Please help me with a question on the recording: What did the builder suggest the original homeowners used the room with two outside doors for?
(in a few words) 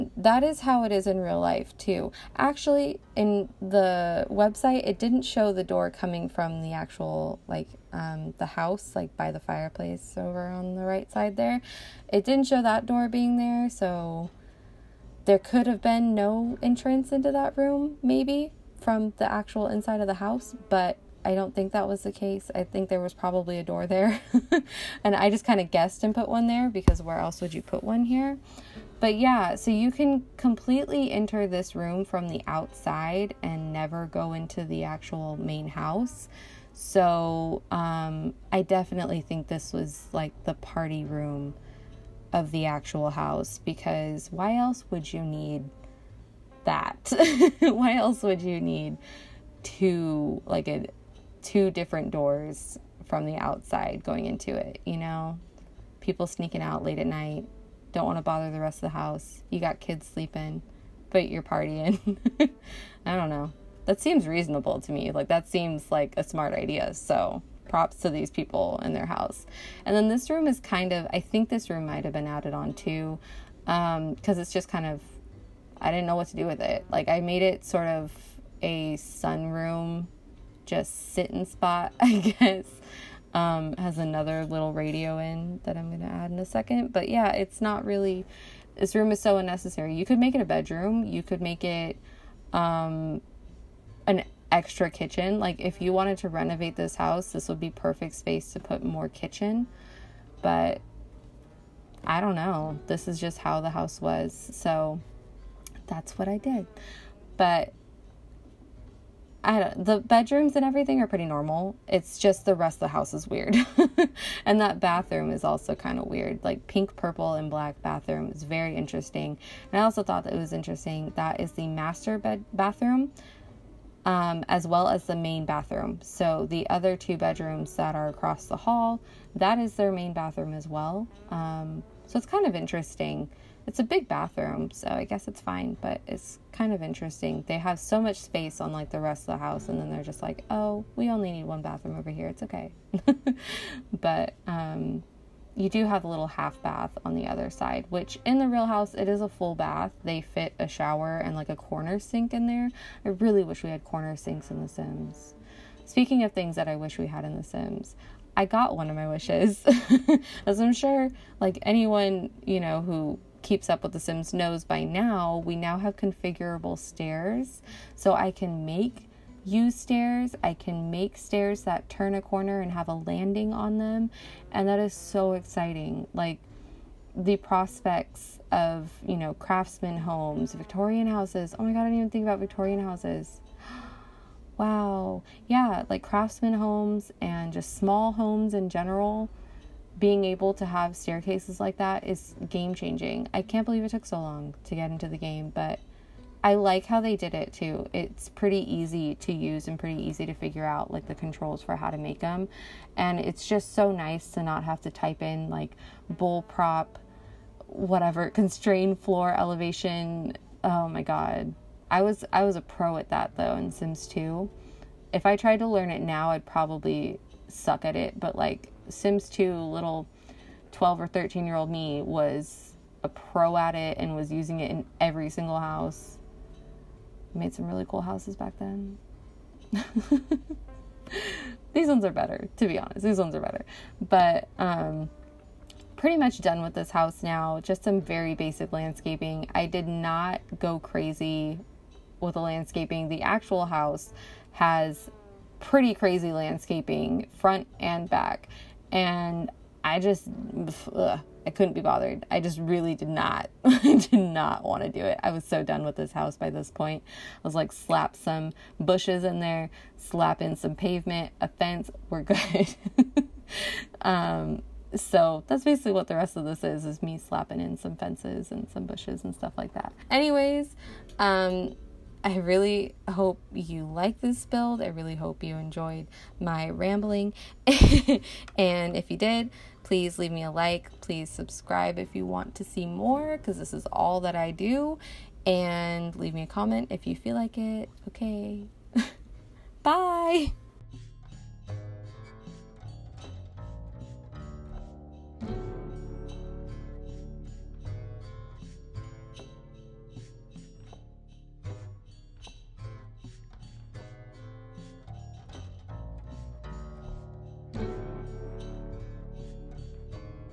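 party room.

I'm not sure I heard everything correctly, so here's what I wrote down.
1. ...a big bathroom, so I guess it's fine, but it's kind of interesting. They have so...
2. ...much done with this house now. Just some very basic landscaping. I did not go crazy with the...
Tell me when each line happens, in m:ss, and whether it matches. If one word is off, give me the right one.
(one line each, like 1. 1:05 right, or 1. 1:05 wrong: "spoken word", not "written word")
1. 2:13 right
2. 3:56 right.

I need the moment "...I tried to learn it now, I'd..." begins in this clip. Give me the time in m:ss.
3:35.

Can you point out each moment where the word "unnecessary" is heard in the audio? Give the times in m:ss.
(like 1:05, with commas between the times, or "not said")
1:29.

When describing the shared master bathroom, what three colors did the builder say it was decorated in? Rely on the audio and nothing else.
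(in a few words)
pink, purple, and black.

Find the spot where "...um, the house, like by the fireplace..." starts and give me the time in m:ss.
0:07.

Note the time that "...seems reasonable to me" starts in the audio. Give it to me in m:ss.
1:03.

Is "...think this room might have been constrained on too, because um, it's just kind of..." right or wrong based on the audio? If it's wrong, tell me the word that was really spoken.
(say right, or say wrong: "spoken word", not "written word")
wrong: "added", not "constrained".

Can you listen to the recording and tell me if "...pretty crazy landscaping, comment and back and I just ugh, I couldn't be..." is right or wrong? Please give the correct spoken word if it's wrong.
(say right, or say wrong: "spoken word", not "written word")
wrong: "front", not "comment".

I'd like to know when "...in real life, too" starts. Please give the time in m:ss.
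0:01.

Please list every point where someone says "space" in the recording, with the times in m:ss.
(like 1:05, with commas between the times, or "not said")
1:38, 2:18.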